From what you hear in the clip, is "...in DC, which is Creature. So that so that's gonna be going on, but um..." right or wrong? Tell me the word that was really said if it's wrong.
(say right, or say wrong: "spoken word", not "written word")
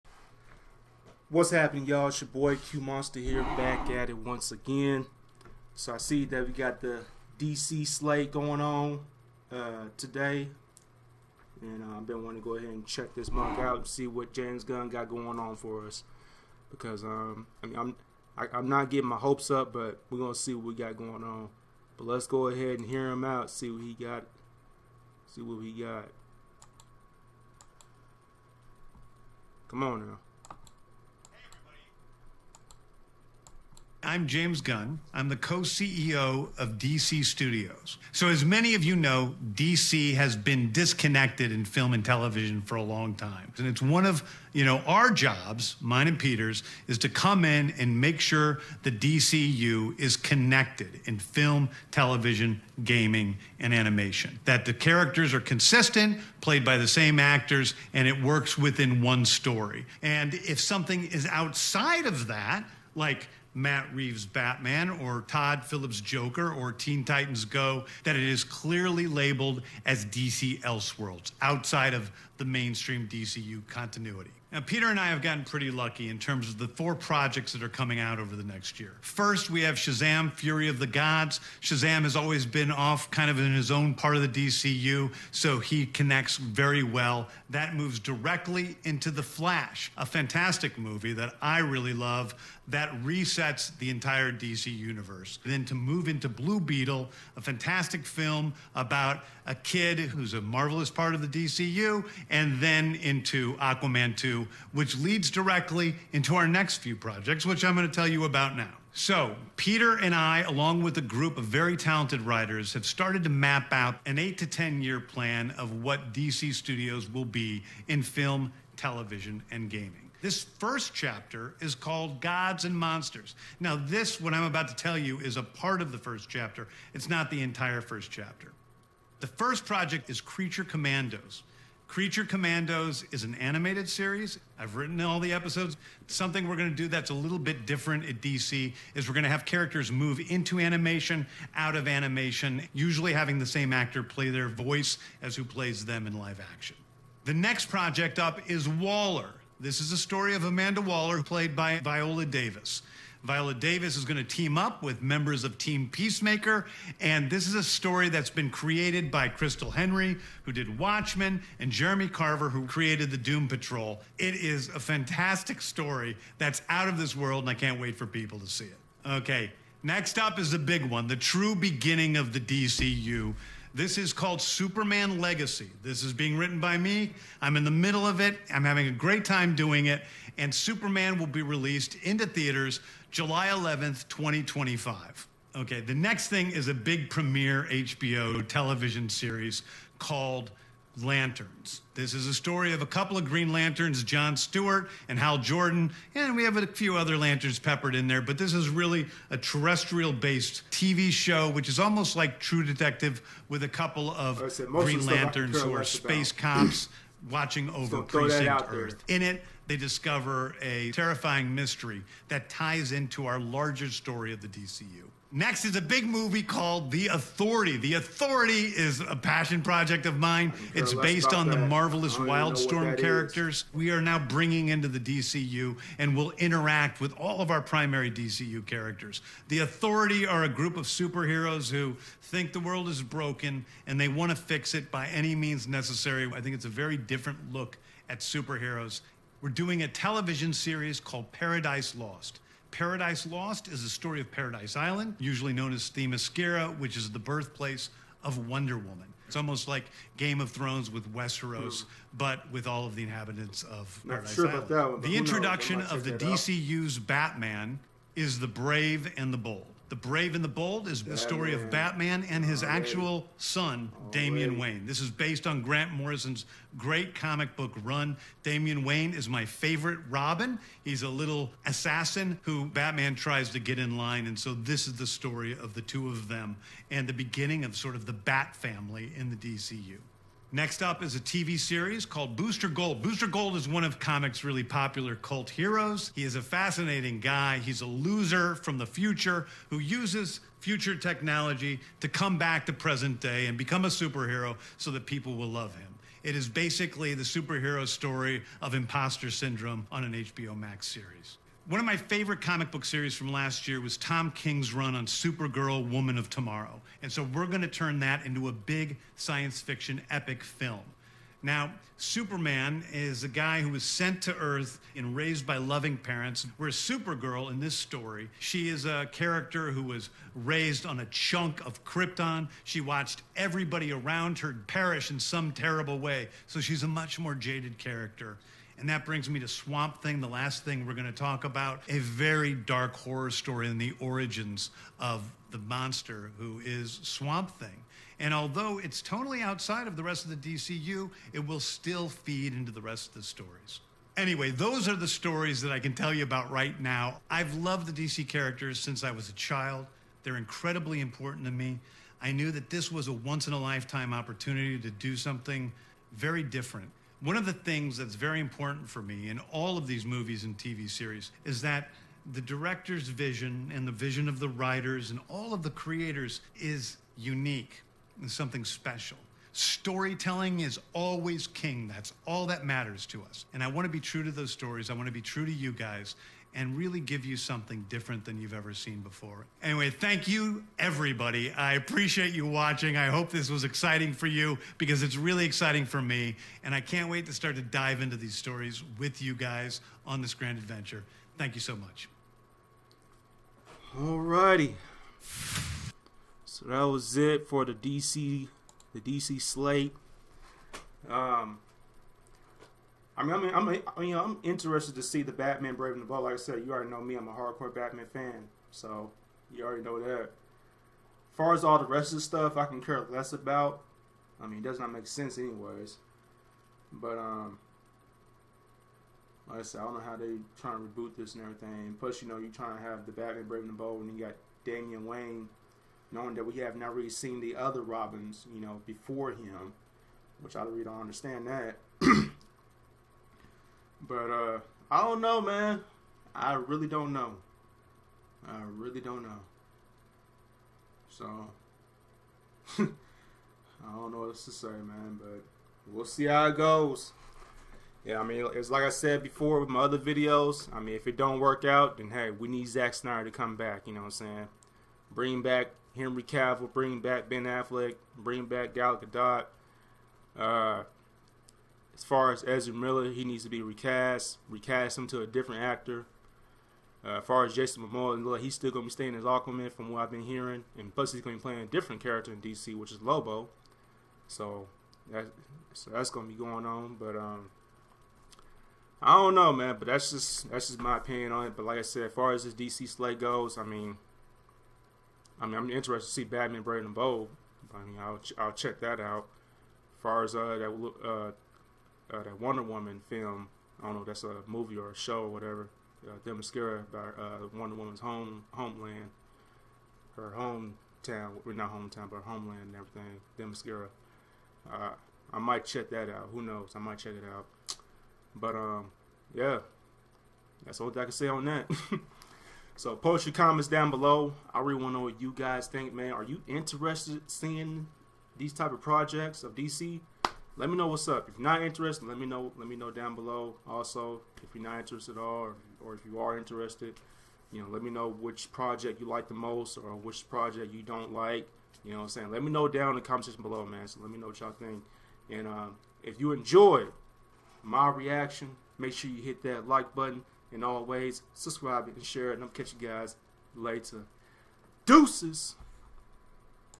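wrong: "Lobo", not "Creature".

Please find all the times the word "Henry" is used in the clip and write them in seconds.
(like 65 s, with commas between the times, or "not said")
159 s, 455 s.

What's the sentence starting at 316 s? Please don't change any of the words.
Whereas Supergirl in this story, she is a character who was raised on a chunk of Krypton.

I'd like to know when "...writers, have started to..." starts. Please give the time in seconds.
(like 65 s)
112 s.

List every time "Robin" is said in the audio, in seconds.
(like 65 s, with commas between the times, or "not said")
270 s, 427 s.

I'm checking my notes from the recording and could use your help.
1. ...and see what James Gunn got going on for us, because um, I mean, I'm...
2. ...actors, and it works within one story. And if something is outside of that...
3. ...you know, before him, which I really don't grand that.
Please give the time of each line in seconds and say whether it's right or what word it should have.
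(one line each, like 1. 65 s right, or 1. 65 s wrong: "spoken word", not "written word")
1. 13 s right
2. 57 s right
3. 428 s wrong: "understand", not "grand".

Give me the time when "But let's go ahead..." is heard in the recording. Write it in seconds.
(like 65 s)
21 s.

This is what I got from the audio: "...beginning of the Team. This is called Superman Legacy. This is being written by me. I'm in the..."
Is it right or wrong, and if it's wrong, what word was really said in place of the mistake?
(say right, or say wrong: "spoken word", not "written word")
wrong: "DCU", not "Team".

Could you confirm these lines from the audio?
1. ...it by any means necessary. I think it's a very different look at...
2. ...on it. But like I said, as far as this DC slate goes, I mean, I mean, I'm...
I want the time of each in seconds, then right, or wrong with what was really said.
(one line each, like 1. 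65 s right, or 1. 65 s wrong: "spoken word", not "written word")
1. 234 s right
2. 481 s right.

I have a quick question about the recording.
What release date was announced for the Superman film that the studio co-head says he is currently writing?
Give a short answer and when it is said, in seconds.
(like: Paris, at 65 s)
July 11th, 2025, at 183 s.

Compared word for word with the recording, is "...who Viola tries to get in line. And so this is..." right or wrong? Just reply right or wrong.
wrong.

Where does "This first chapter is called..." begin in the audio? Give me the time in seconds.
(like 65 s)
120 s.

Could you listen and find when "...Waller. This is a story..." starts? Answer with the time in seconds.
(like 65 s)
148 s.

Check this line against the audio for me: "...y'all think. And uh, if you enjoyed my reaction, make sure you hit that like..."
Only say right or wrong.
right.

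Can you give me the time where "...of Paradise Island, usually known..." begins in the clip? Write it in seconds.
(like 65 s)
244 s.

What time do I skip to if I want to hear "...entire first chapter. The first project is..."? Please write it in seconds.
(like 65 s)
127 s.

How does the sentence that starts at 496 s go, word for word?
Uh, Demascara by uh, Wonder Woman's home homeland, her hometown, well, not hometown, but her homeland and everything.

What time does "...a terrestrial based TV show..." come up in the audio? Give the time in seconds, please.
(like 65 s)
199 s.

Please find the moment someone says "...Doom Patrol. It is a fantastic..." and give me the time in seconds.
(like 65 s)
163 s.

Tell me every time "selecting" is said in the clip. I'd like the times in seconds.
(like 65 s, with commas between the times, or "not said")
not said.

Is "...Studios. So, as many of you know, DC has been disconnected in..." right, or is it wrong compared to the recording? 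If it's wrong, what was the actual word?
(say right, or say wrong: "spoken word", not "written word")
right.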